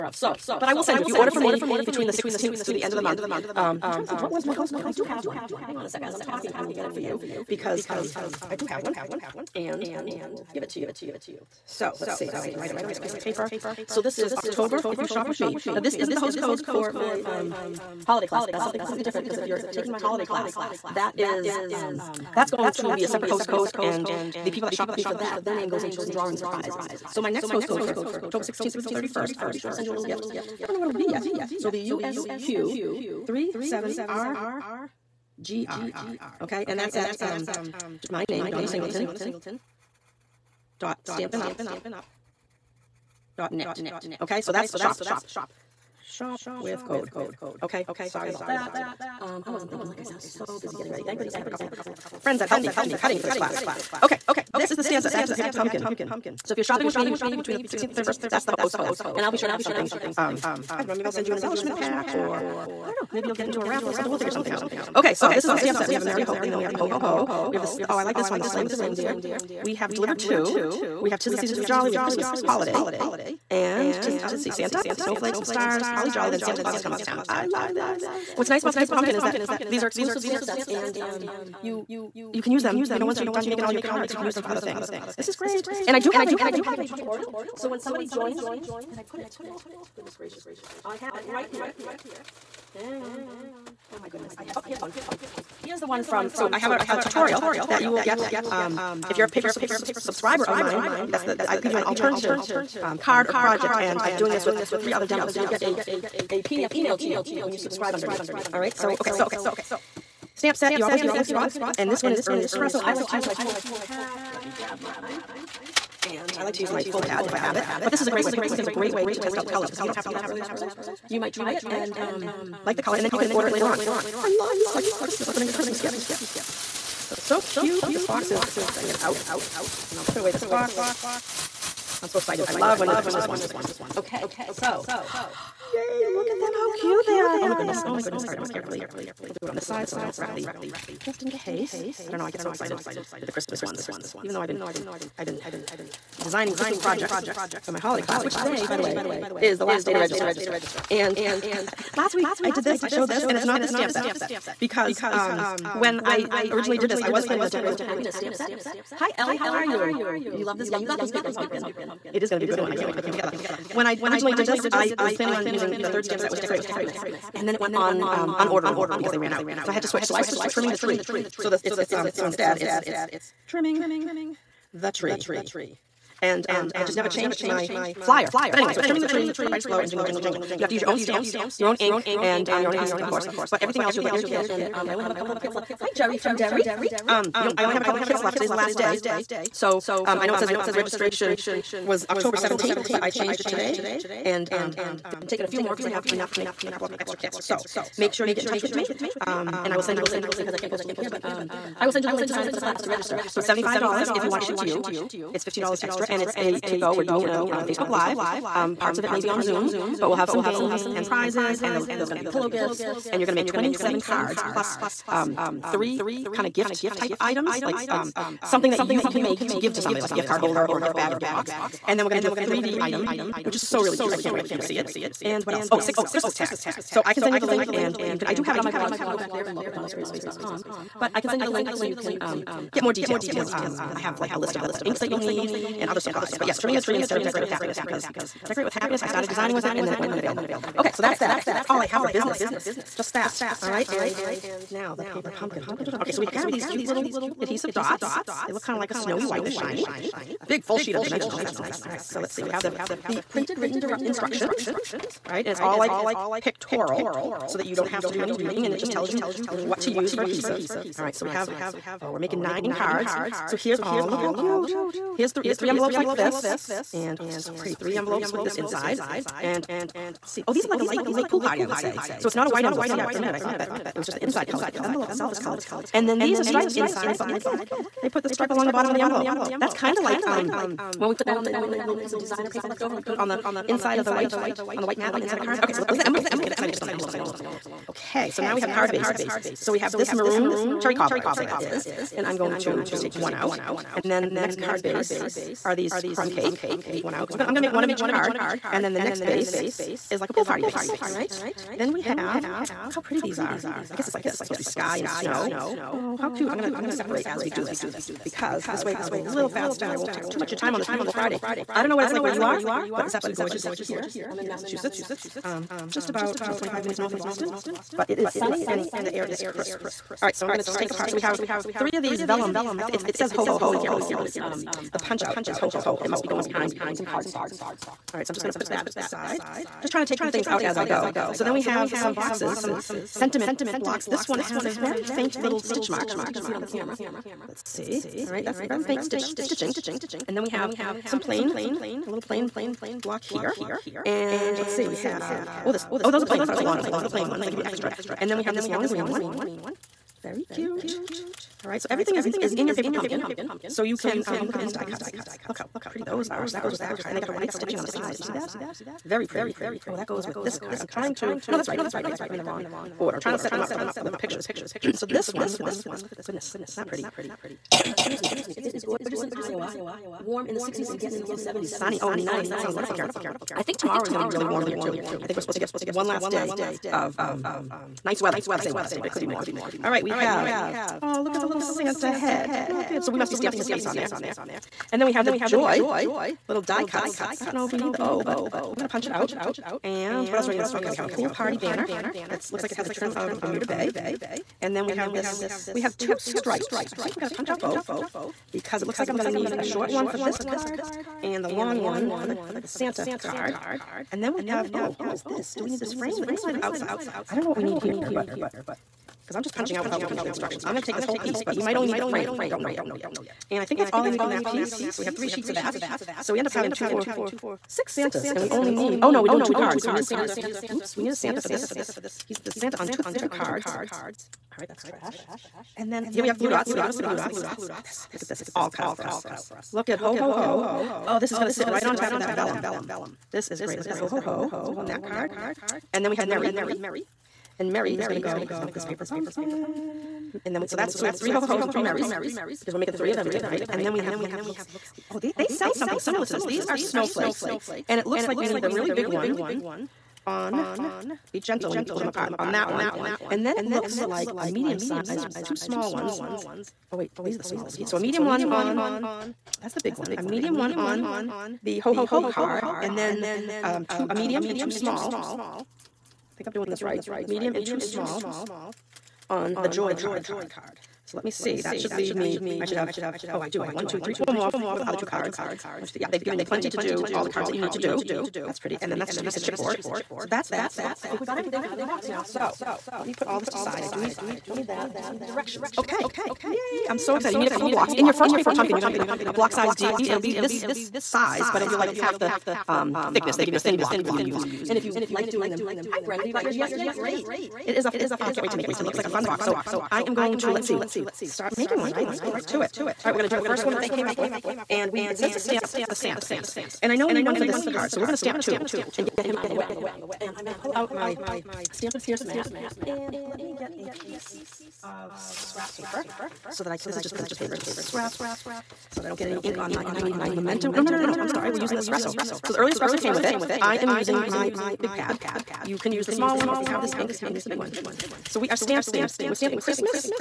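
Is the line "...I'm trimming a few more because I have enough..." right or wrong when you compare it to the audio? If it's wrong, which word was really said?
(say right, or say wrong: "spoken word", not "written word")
wrong: "taking", not "trimming".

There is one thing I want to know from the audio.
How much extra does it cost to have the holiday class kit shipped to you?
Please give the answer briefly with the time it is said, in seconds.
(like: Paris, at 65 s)
$15, at 205 s.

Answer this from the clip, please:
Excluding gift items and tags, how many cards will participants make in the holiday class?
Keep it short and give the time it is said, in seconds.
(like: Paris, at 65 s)
27, at 213 s.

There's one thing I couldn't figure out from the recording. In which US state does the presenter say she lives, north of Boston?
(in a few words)
Massachusetts.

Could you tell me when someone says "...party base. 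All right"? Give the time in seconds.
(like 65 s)
300 s.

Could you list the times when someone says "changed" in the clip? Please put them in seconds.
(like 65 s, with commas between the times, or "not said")
177 s, 193 s.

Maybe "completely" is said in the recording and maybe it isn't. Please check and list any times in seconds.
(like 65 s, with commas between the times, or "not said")
18 s.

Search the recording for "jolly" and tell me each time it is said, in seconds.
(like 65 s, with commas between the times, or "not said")
71 s, 76 s.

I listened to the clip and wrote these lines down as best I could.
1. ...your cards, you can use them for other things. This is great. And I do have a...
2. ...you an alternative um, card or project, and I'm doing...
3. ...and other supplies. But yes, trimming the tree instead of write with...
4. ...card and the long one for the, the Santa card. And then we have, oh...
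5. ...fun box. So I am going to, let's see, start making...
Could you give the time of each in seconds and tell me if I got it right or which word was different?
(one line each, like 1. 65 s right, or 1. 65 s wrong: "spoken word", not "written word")
1. 83 s right
2. 101 s right
3. 235 s wrong: "decorate", not "write"
4. 400 s right
5. 499 s right.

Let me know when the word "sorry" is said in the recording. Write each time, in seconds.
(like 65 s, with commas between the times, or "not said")
48 s, 521 s.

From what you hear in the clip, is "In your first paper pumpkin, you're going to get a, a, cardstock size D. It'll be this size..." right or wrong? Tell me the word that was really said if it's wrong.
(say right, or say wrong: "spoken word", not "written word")
wrong: "block", not "cardstock".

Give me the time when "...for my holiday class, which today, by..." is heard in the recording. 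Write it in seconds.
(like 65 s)
147 s.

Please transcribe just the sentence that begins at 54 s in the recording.
Okay, this is the stamp set, back to the paper pumpkin.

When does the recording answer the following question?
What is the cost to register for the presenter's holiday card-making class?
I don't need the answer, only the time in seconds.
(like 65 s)
203 s.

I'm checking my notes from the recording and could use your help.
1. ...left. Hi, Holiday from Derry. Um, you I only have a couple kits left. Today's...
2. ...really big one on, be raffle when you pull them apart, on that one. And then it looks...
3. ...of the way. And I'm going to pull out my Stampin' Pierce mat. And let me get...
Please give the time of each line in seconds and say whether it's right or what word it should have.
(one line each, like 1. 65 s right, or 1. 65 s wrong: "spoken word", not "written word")
1. 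185 s wrong: "Jerry", not "Holiday"
2. 448 s wrong: "gentle", not "raffle"
3. 509 s right.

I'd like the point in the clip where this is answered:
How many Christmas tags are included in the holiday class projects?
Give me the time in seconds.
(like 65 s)
225 s.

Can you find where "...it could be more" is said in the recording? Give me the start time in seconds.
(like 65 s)
379 s.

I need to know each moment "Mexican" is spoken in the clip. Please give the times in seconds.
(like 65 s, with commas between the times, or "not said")
not said.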